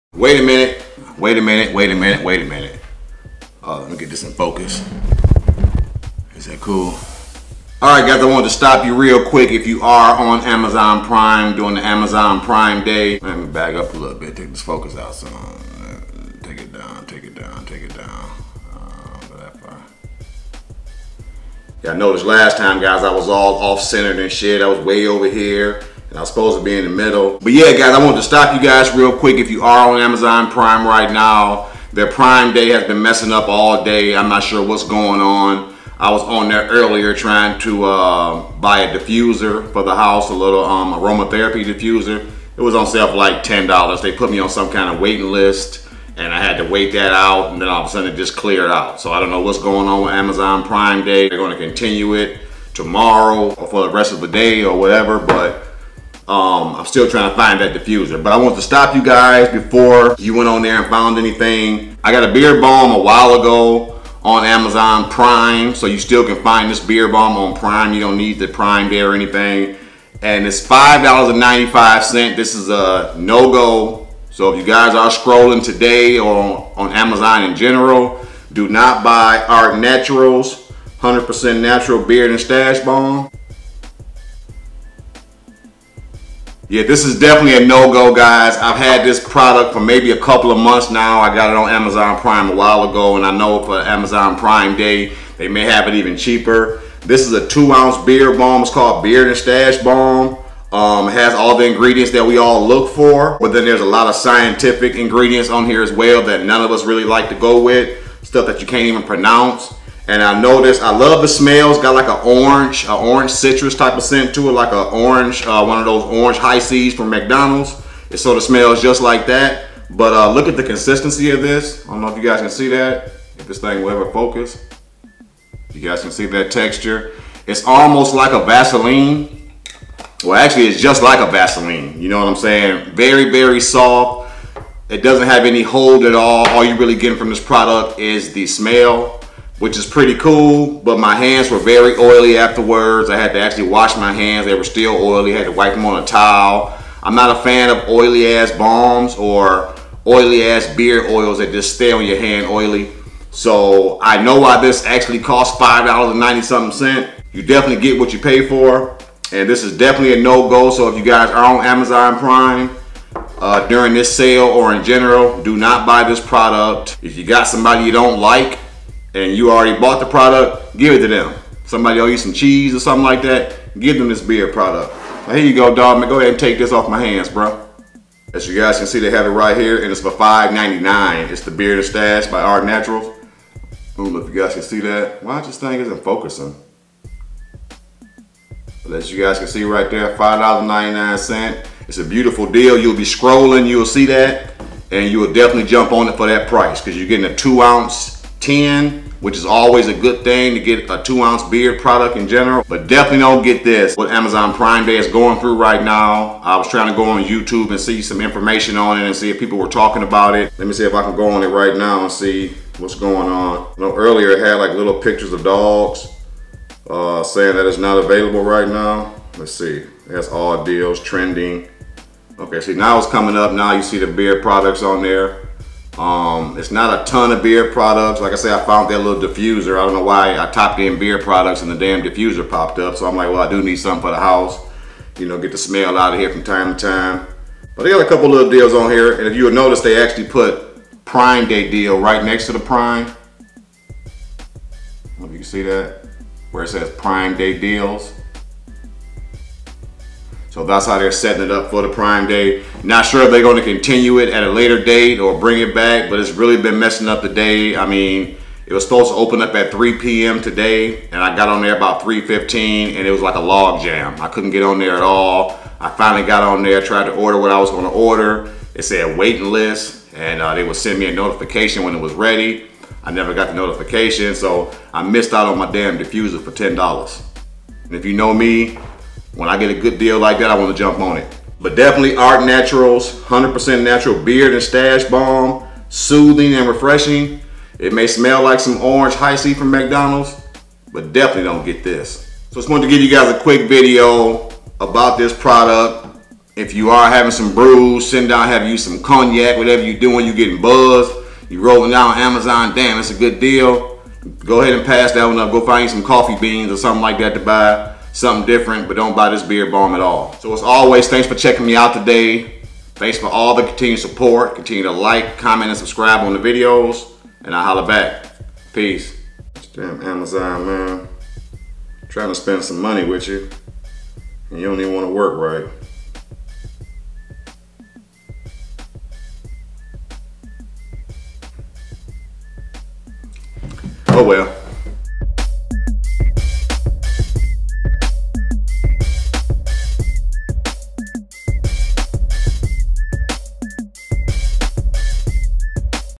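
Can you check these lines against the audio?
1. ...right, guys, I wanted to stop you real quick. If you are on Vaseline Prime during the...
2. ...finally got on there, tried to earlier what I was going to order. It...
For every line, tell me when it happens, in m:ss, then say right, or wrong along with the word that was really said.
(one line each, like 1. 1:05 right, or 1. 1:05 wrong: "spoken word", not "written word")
1. 0:07 wrong: "Amazon", not "Vaseline"
2. 4:25 wrong: "order", not "earlier".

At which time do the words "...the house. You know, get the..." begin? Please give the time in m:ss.
3:54.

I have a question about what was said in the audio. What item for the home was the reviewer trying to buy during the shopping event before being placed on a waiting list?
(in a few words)
aromatherapy diffuser.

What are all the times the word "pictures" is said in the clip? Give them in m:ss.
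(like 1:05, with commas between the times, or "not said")
3:35.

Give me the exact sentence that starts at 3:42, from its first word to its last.
Okay, see now it's coming up, now you see the beer products on there.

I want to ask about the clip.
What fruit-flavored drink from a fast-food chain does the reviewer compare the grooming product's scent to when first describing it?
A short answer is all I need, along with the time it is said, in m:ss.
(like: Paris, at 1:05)
Hi-C, at 1:56.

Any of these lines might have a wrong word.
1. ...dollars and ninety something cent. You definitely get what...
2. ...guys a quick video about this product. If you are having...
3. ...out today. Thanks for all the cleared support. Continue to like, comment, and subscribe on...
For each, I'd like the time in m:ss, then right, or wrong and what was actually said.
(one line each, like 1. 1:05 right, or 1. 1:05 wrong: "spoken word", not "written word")
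1. 2:35 right
2. 4:53 right
3. 5:11 wrong: "continued", not "cleared".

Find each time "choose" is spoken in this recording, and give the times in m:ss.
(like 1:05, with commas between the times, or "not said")
not said.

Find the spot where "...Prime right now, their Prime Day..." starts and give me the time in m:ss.
0:30.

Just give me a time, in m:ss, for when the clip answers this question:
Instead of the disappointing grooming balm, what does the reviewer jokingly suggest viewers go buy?
5:06.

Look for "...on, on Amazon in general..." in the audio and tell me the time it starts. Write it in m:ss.
1:16.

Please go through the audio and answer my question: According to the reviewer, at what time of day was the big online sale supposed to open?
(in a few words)
3 p.m.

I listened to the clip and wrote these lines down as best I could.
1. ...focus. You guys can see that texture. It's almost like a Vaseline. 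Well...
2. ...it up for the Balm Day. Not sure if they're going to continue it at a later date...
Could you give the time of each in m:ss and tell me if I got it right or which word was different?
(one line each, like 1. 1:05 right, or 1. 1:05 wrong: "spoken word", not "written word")
1. 2:04 right
2. 4:11 wrong: "Prime", not "Balm".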